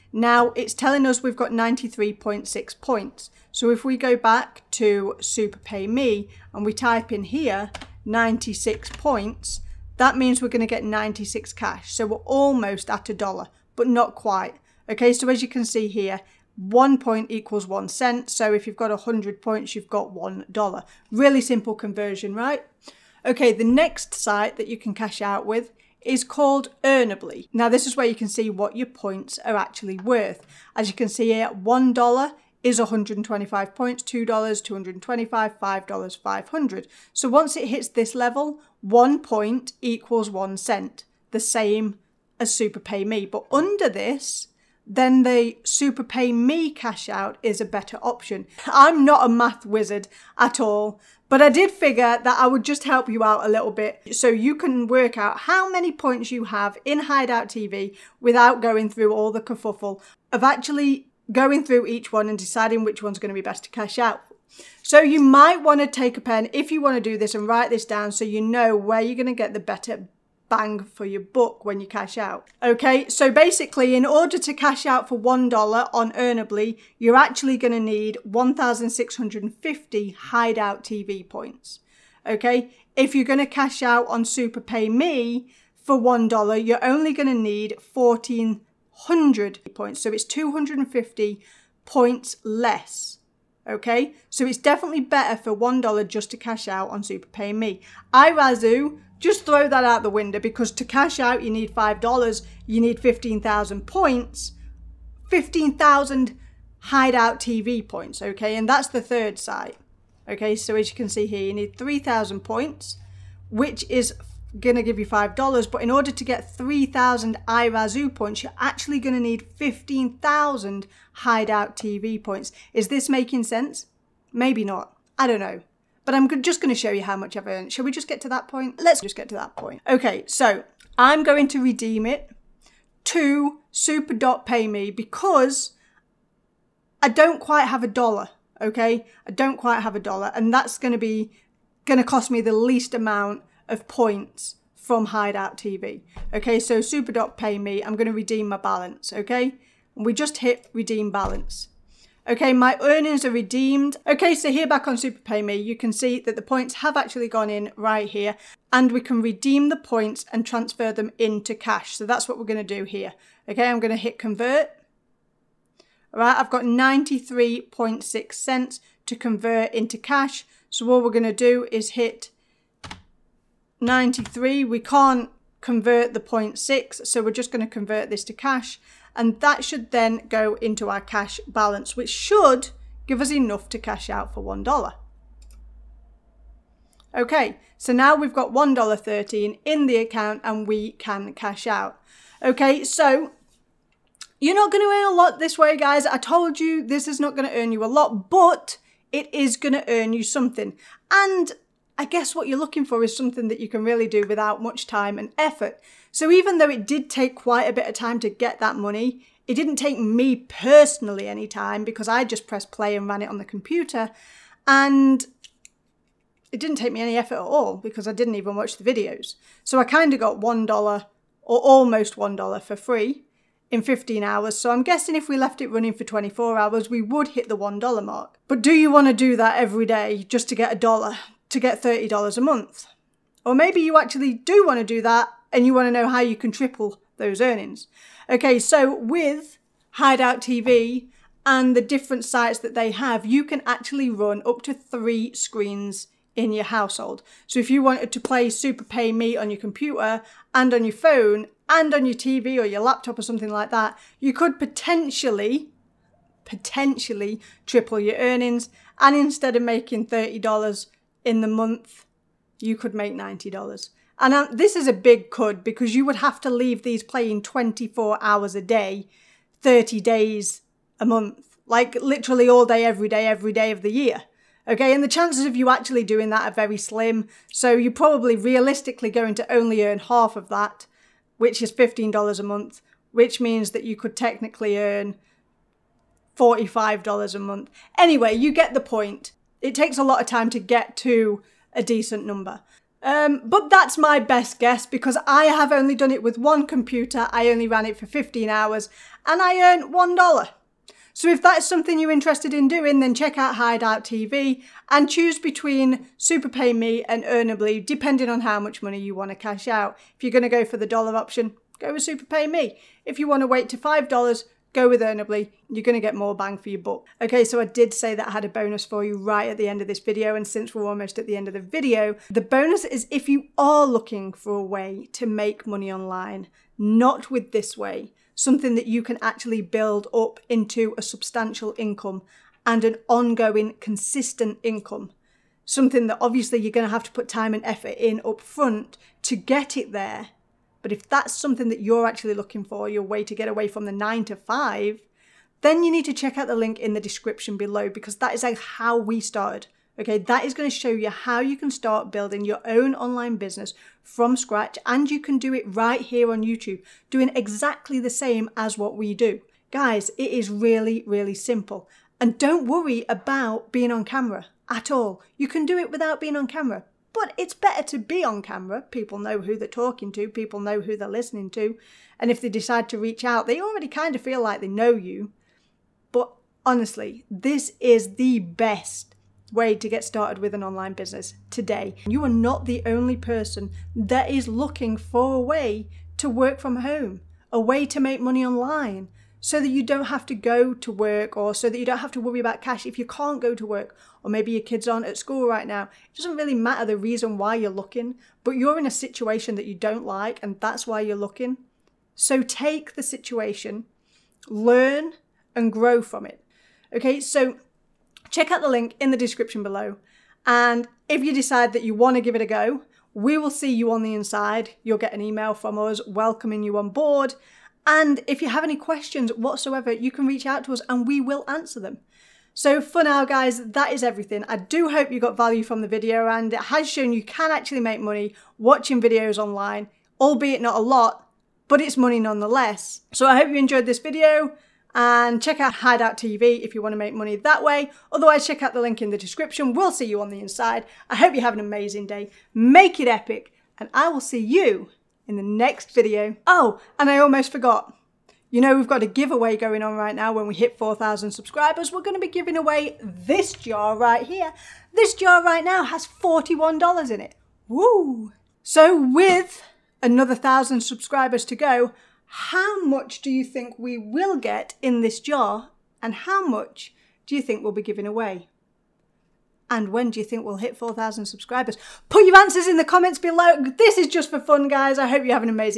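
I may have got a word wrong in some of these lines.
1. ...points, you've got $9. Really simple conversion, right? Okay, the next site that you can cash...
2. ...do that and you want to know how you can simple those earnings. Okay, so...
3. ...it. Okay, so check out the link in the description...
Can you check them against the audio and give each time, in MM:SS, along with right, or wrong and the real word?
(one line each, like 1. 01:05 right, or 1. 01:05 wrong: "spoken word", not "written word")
1. 00:19 wrong: "1", not "9"
2. 03:54 wrong: "triple", not "simple"
3. 06:46 right.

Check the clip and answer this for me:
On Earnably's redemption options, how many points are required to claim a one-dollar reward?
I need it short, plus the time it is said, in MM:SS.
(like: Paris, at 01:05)
125, at 00:32.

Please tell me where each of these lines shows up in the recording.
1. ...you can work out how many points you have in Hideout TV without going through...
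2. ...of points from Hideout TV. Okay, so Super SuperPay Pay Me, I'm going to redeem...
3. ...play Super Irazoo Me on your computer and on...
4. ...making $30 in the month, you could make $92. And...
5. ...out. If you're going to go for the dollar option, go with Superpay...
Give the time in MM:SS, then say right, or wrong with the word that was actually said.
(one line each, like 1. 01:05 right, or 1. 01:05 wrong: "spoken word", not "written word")
1. 00:54 right
2. 02:23 wrong: "Dot", not "SuperPay"
3. 04:08 wrong: "Pay", not "Irazoo"
4. 04:19 wrong: "90", not "92"
5. 05:09 right.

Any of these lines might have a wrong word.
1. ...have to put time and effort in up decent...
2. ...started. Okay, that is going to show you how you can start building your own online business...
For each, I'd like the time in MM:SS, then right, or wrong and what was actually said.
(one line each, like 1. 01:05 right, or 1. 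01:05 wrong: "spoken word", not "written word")
1. 05:36 wrong: "front", not "decent"
2. 05:49 right.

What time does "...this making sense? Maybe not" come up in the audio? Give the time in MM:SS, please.
02:02.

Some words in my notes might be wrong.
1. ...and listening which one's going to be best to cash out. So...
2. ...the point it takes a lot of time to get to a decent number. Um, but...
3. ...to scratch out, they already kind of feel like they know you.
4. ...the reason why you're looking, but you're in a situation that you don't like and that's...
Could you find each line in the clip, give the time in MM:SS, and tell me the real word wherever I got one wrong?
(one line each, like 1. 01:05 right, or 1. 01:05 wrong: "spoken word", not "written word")
1. 01:02 wrong: "deciding", not "listening"
2. 04:48 right
3. 06:12 wrong: "reach", not "scratch"
4. 06:36 right.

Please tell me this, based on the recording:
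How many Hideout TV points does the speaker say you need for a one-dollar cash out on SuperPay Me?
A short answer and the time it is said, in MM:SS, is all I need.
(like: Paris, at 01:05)
1,400, at 01:27.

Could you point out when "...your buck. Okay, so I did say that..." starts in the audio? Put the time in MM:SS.
05:16.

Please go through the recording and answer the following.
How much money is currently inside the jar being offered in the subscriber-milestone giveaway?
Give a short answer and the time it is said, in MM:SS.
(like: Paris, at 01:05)
$41, at 07:36.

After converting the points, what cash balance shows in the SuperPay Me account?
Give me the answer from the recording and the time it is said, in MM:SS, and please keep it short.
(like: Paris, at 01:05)
$1.13, at 03:08.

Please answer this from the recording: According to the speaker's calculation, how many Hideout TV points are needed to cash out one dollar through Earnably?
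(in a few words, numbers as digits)
1,650.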